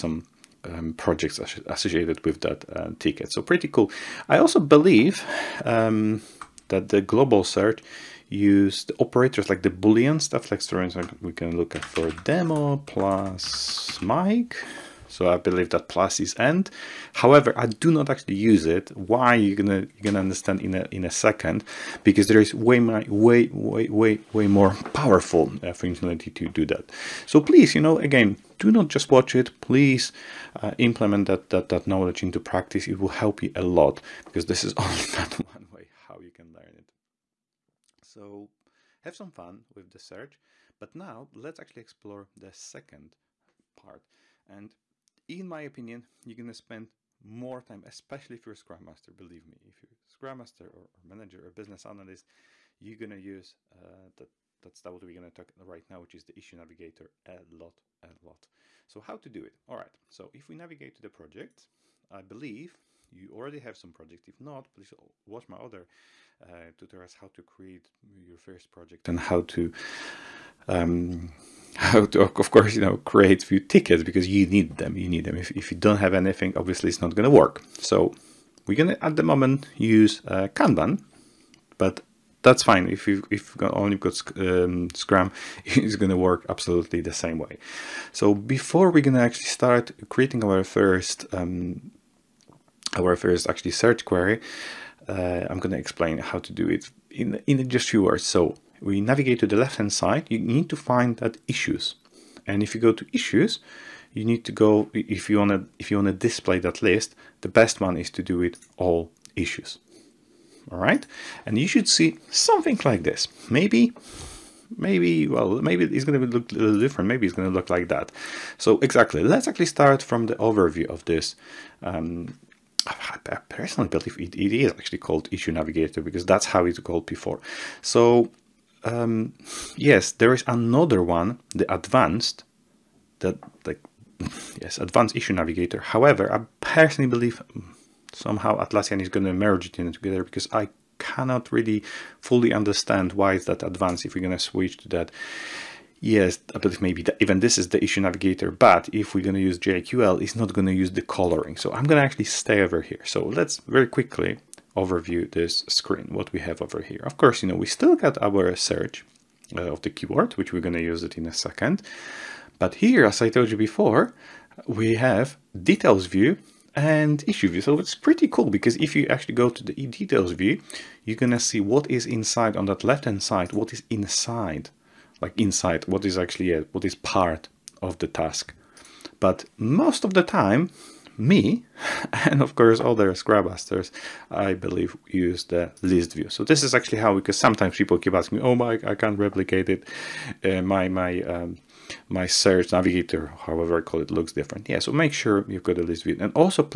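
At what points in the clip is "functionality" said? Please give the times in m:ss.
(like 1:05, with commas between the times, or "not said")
0:25.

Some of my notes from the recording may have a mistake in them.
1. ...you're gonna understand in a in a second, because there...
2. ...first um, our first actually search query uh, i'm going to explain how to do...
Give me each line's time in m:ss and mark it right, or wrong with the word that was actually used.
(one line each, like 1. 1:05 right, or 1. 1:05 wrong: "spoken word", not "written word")
1. 0:19 right
2. 1:30 right.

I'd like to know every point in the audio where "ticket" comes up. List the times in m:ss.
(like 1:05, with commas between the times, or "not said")
0:02, 1:13.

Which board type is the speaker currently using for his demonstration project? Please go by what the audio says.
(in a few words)
Kanban.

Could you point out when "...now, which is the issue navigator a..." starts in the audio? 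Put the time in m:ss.
0:55.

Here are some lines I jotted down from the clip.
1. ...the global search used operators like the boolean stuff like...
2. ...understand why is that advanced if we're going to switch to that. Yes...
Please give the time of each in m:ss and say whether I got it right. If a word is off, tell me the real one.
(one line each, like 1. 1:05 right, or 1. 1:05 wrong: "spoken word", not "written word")
1. 0:06 right
2. 2:22 right.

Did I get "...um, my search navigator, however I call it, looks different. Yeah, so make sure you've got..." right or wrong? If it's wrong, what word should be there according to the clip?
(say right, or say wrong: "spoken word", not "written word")
right.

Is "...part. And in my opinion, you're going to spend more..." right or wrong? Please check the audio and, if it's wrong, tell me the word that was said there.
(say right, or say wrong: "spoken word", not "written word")
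right.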